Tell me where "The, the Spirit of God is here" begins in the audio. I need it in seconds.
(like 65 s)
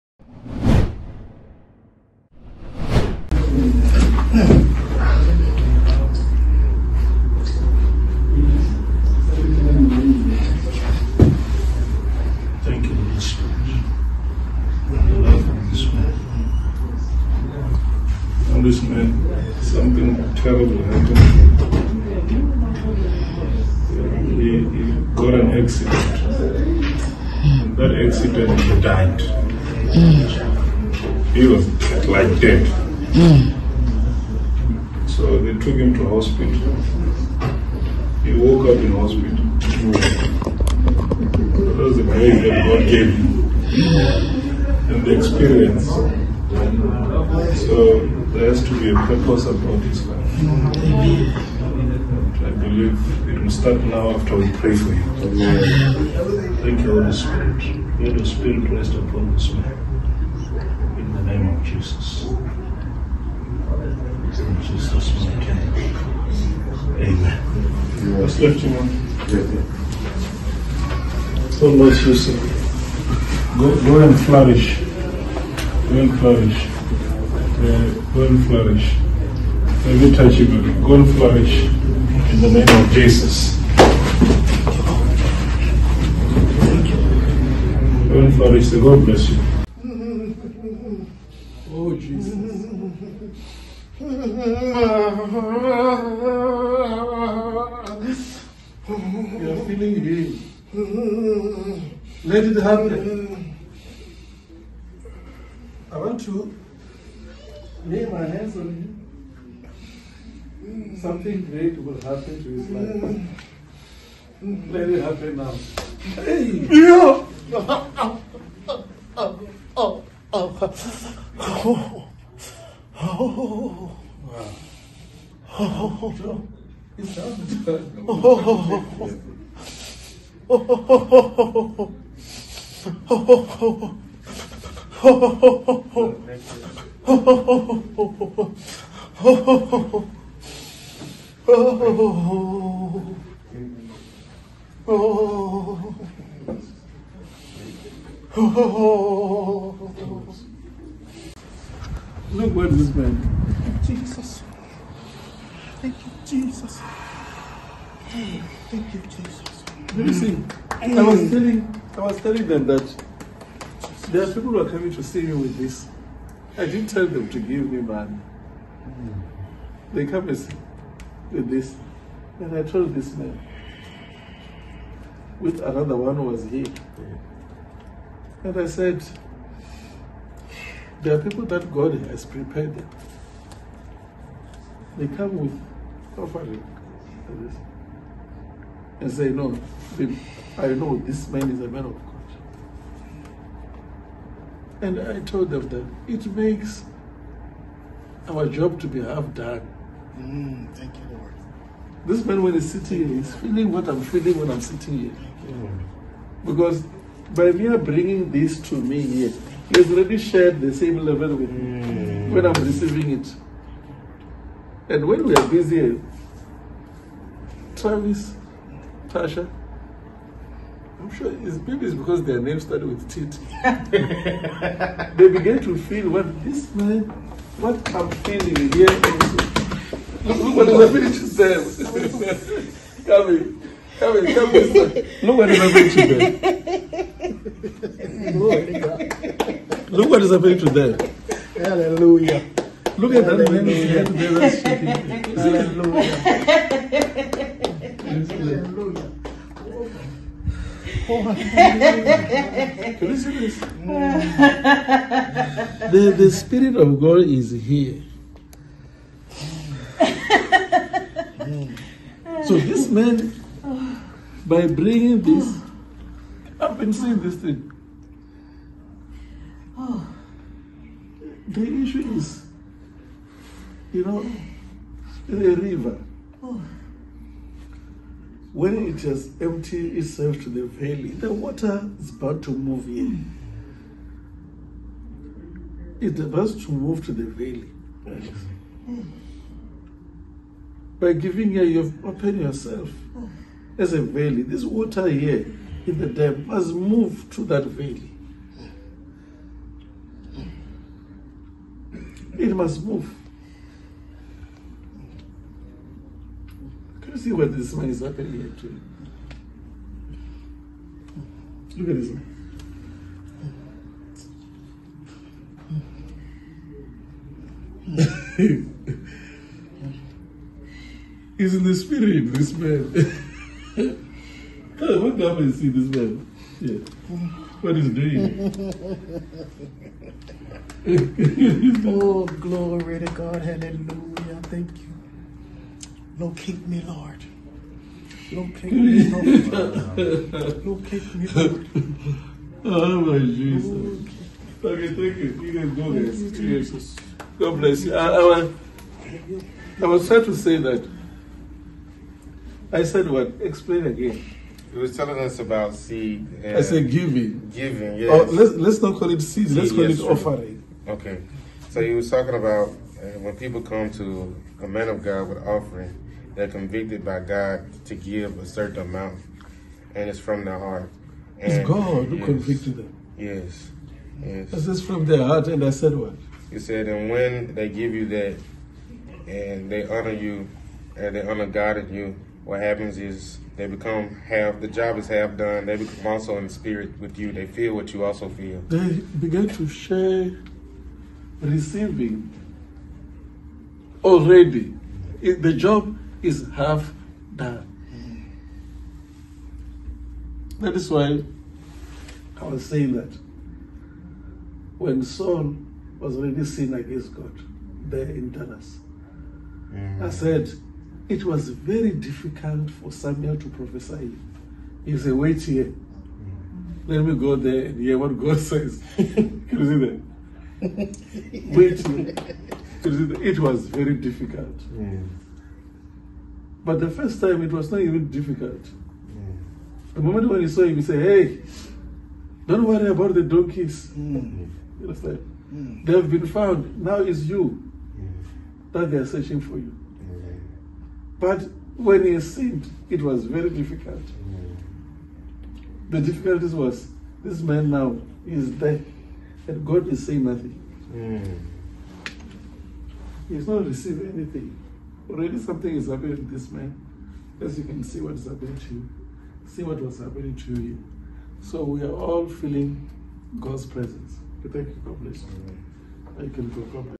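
255 s.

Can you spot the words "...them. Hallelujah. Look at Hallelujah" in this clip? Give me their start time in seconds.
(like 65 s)
240 s.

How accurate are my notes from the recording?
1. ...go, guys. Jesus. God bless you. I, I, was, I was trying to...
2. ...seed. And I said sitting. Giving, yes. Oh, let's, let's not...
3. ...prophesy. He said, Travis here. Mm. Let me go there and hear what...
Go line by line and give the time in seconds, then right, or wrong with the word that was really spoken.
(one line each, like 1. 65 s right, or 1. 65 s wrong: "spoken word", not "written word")
1. 345 s right
2. 355 s wrong: "giving", not "sitting"
3. 413 s wrong: "Wait", not "Travis".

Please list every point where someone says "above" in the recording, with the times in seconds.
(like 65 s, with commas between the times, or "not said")
not said.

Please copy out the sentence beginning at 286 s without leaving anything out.
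It's about to move to the valley.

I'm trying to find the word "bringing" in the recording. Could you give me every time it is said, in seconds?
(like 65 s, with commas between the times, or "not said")
207 s, 264 s.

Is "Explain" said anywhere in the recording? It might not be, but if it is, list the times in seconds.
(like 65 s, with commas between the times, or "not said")
353 s.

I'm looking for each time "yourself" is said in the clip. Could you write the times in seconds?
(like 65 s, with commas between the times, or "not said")
292 s.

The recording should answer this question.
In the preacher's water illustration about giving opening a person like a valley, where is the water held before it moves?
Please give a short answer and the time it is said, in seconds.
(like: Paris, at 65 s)
The dam, at 296 s.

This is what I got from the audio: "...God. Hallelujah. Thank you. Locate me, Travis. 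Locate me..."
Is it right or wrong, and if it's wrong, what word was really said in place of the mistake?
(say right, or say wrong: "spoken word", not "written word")
wrong: "Lord", not "Travis".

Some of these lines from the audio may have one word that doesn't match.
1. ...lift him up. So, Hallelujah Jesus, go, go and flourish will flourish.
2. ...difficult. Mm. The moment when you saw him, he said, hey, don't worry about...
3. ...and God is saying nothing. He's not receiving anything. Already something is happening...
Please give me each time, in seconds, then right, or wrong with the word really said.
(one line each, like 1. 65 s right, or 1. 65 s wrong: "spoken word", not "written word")
1. 68 s wrong: "Lord", not "Hallelujah"
2. 428 s right
3. 449 s right.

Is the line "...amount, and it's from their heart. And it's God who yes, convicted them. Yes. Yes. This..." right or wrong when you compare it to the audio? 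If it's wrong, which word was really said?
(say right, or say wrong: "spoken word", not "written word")
right.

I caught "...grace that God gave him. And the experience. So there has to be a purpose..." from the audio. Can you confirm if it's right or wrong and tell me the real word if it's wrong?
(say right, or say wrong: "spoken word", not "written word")
right.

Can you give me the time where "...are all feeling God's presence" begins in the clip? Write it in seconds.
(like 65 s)
461 s.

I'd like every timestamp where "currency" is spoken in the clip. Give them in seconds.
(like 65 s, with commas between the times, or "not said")
not said.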